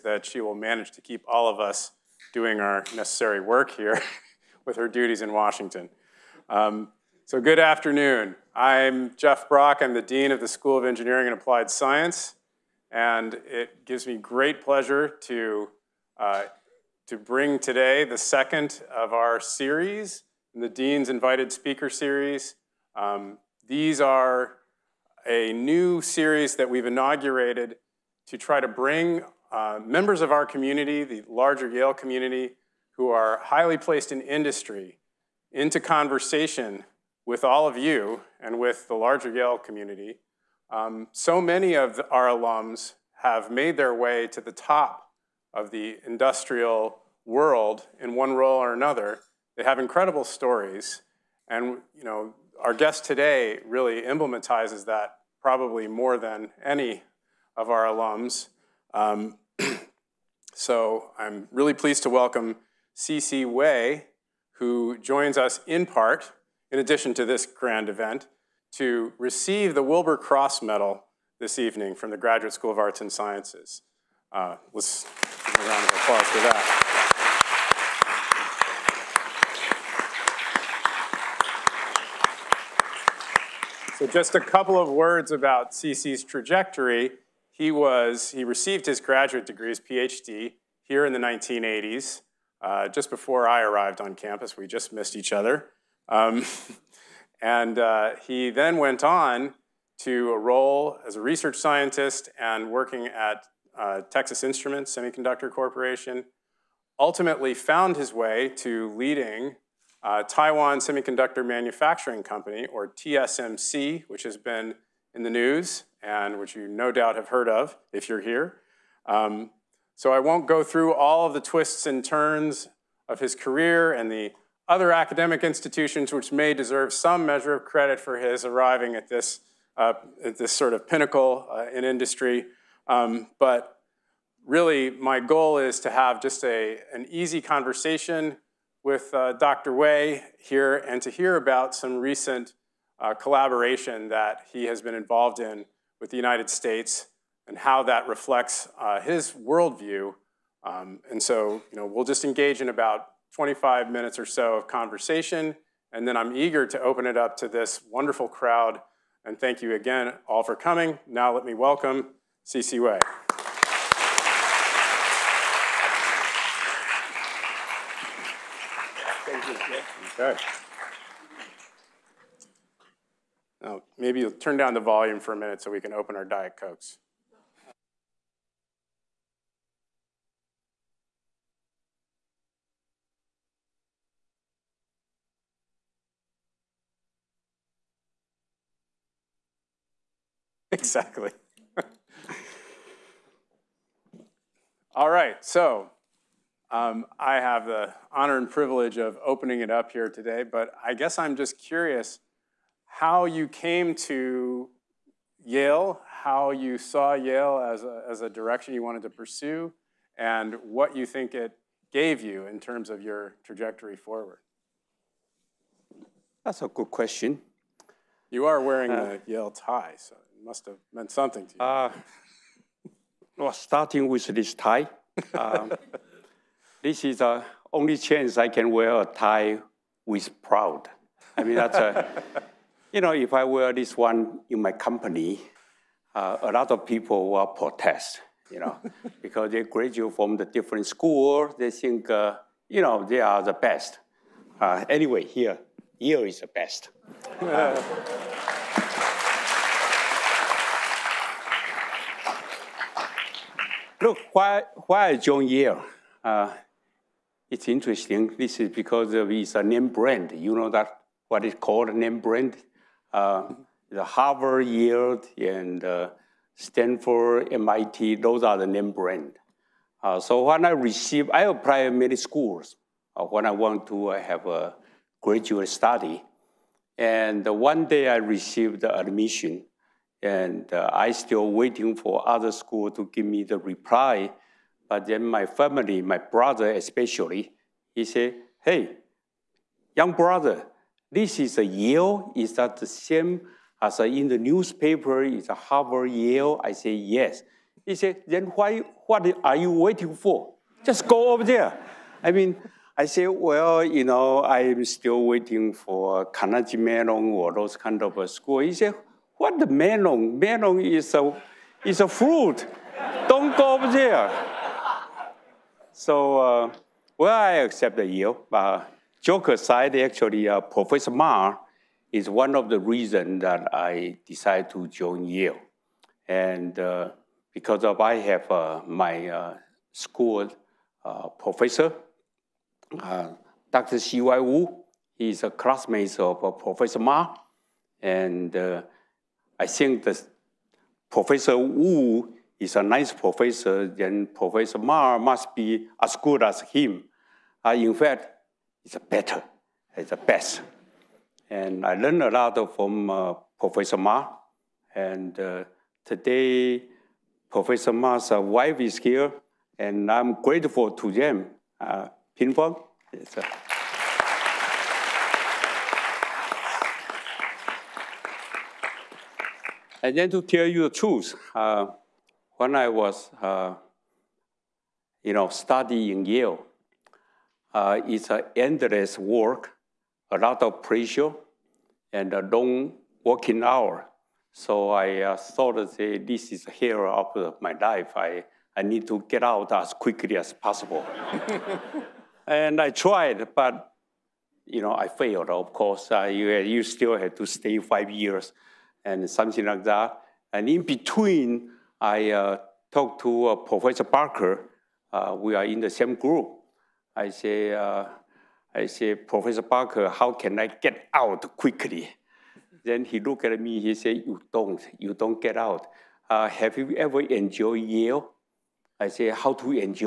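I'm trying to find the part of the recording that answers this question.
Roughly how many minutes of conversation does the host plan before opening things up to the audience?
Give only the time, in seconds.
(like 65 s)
153 s.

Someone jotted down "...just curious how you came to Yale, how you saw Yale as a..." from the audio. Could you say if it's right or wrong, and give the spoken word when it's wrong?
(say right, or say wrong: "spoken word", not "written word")
right.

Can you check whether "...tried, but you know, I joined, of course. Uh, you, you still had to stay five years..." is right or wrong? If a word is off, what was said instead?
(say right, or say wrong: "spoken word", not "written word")
wrong: "failed", not "joined".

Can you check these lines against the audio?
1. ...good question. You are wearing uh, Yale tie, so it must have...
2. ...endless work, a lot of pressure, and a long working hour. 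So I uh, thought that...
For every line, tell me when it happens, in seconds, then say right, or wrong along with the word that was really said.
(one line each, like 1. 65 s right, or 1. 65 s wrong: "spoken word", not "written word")
1. 216 s right
2. 378 s right.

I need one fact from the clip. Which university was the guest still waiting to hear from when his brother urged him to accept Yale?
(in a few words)
Carnegie Mellon.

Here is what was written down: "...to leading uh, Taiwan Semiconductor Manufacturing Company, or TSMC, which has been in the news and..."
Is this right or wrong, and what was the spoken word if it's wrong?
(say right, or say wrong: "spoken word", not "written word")
right.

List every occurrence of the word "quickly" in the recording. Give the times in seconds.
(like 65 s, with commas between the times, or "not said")
389 s, 411 s.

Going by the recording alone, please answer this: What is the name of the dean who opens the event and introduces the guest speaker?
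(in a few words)
Jeff Brock.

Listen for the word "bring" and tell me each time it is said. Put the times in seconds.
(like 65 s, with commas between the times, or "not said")
17 s, 28 s.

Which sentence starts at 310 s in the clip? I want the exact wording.
Melon is a, is a fruit.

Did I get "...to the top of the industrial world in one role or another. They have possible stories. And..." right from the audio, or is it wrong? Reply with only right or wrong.
wrong.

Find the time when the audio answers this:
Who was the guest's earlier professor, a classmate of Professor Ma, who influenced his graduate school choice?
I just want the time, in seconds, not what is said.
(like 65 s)
333 s.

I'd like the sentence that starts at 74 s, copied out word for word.
Uh, let's give a round of applause for that.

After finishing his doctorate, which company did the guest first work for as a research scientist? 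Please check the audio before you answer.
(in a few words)
Texas Instruments.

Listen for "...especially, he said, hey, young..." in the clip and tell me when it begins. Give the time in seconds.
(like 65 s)
286 s.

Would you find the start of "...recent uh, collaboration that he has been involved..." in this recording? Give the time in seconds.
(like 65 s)
141 s.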